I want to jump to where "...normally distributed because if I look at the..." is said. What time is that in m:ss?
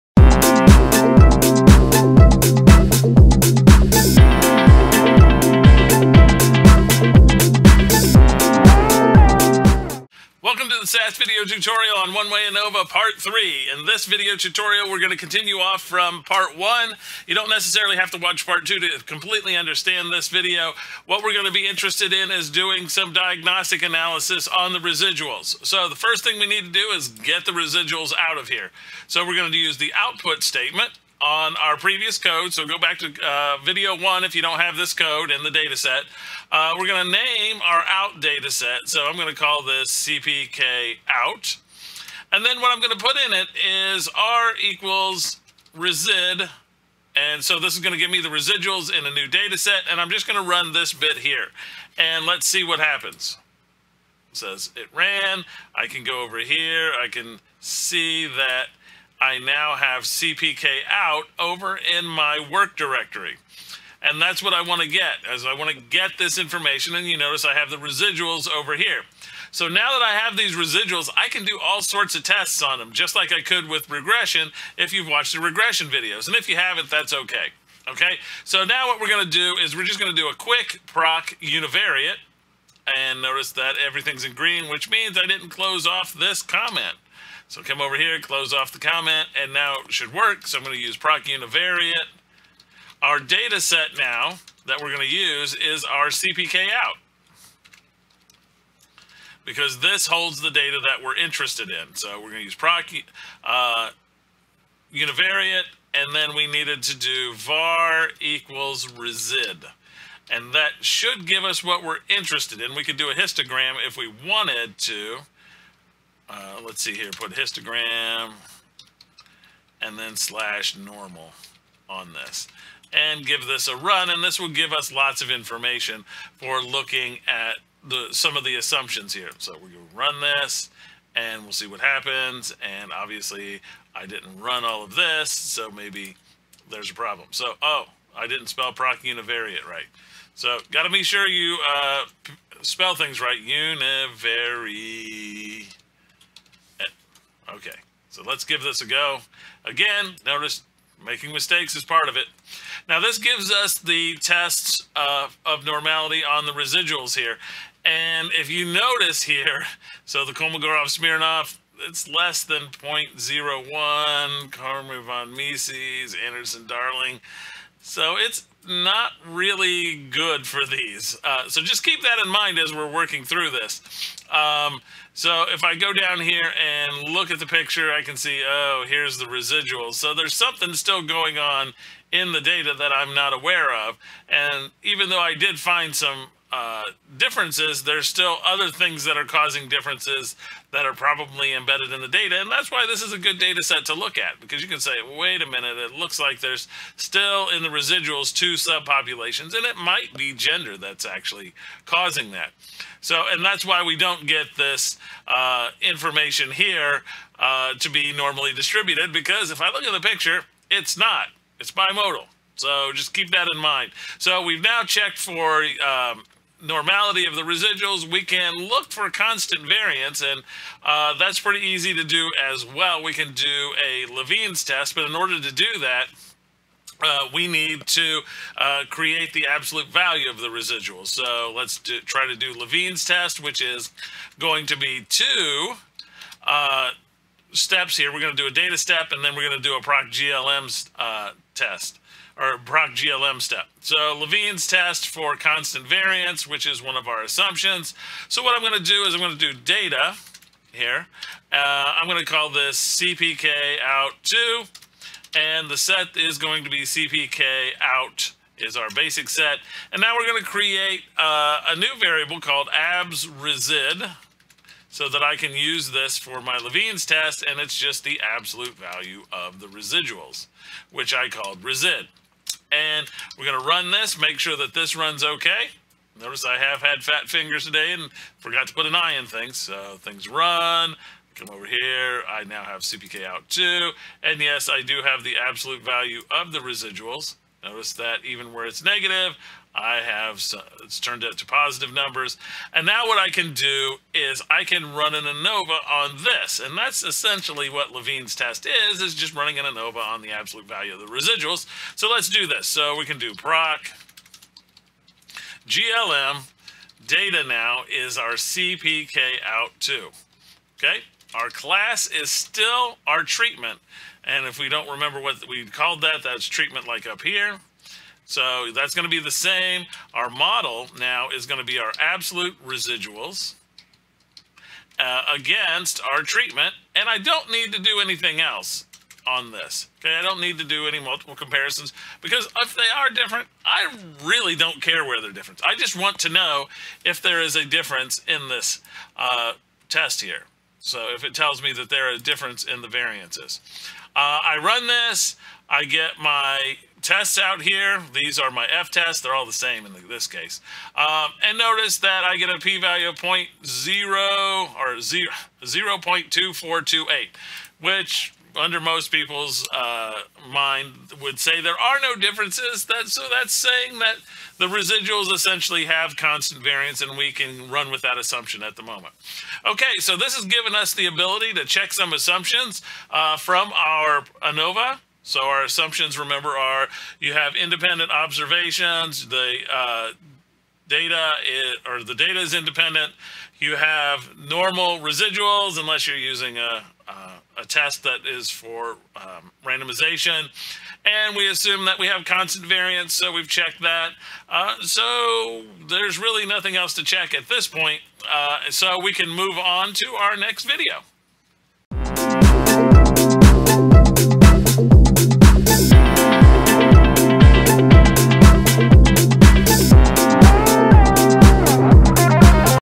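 3:28.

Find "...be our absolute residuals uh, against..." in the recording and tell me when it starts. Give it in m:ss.
5:21.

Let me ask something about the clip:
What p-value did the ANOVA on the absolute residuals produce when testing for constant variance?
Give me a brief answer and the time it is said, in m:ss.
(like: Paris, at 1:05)
0.2428, at 5:55.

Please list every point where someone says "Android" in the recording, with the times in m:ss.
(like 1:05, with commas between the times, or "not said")
not said.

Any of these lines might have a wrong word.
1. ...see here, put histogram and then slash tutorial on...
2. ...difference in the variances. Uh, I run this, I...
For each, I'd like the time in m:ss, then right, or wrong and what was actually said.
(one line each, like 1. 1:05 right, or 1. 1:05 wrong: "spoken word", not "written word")
1. 1:56 wrong: "normal", not "tutorial"
2. 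5:42 right.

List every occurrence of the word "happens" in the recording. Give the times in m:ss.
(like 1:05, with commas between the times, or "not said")
0:52, 2:11.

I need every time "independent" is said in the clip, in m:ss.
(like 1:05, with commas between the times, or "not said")
6:17, 6:22.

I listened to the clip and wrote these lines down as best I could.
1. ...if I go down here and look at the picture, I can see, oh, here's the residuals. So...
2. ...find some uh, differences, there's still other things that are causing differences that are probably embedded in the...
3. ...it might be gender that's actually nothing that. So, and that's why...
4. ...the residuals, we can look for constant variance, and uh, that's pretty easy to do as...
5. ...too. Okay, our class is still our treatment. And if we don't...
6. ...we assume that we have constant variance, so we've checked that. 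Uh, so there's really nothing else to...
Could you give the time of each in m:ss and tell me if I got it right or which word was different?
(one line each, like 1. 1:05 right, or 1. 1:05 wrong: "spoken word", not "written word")
1. 2:55 right
2. 3:05 right
3. 3:19 wrong: "causing", not "nothing"
4. 3:37 right
5. 5:09 right
6. 6:31 right.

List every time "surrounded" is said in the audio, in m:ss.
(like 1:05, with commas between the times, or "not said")
not said.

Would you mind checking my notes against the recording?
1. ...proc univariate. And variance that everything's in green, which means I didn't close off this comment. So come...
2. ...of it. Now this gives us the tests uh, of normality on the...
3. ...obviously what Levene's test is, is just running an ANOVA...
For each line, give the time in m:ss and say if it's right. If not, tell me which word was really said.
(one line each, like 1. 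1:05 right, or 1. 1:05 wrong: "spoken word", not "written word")
1. 1:20 wrong: "notice", not "variance"
2. 2:32 right
3. 4:57 wrong: "essentially", not "obviously".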